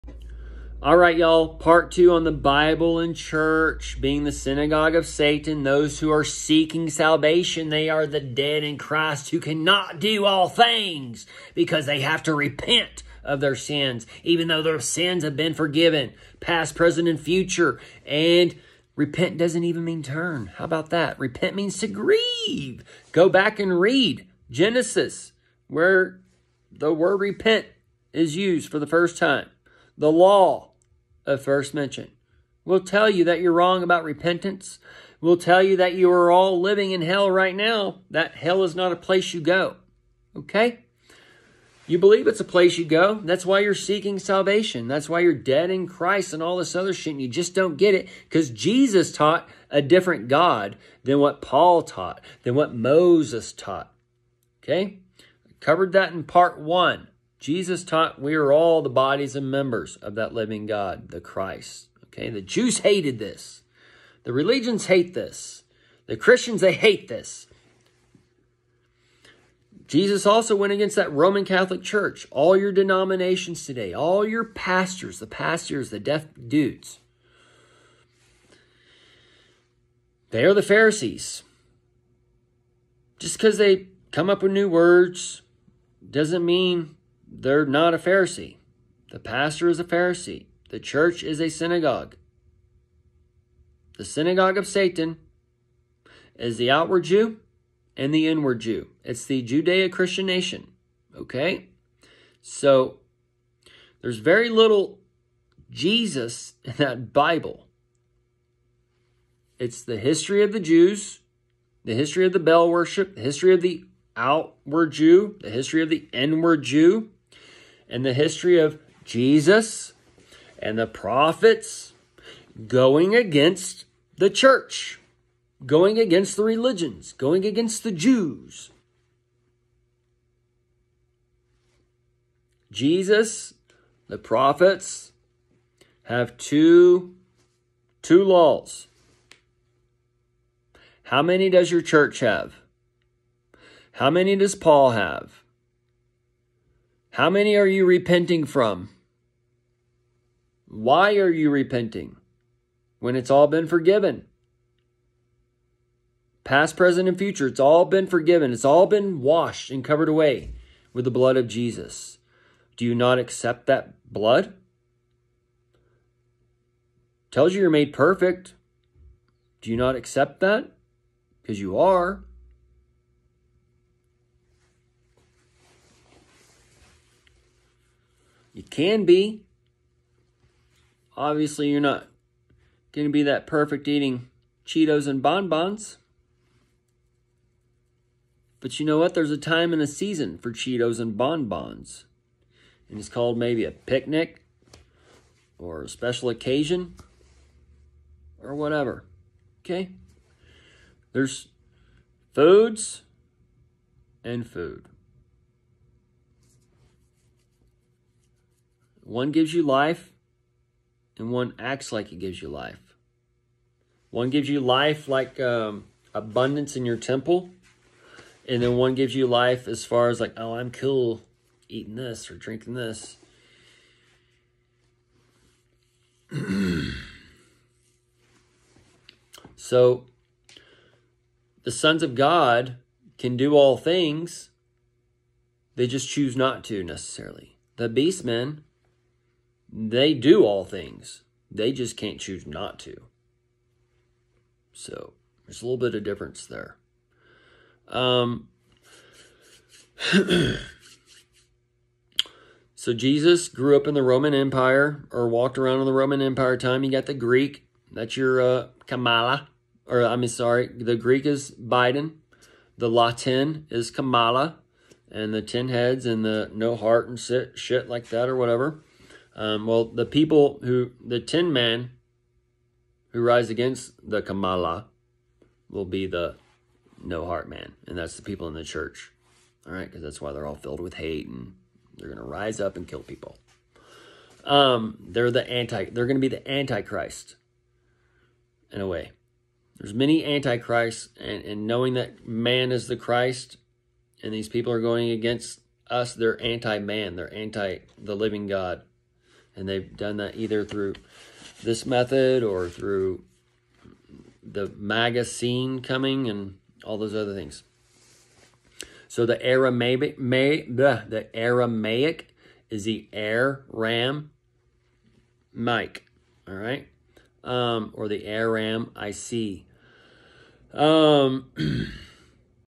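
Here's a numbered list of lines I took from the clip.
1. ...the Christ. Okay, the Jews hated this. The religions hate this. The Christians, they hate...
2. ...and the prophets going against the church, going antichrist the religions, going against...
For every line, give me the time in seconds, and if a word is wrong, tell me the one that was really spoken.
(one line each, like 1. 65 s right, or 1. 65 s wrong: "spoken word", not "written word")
1. 61 s right
2. 120 s wrong: "against", not "antichrist".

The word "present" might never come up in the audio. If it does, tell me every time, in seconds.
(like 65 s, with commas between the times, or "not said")
16 s, 156 s.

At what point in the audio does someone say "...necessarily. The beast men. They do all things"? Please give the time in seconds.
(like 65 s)
236 s.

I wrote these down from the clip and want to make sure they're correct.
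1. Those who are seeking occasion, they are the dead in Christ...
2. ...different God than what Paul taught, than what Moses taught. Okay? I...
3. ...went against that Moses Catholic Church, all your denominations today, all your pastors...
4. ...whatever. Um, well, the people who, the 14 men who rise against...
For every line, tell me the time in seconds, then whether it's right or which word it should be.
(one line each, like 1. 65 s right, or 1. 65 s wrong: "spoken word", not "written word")
1. 5 s wrong: "salvation", not "occasion"
2. 49 s right
3. 70 s wrong: "Roman", not "Moses"
4. 268 s wrong: "10", not "14".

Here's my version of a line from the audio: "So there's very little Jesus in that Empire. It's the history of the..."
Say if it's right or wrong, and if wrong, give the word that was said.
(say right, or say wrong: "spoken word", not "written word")
wrong: "Bible", not "Empire".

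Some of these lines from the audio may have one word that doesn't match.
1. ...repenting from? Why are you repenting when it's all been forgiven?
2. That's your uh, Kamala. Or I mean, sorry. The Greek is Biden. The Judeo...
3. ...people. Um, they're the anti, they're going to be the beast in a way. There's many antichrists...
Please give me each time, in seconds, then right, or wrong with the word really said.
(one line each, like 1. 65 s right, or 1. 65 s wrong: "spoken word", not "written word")
1. 147 s right
2. 257 s wrong: "Latin", not "Judeo"
3. 283 s wrong: "antichrist", not "beast".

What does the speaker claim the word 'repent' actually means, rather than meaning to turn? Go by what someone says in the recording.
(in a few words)
To grieve.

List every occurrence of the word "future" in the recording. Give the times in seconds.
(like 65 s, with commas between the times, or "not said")
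17 s, 157 s.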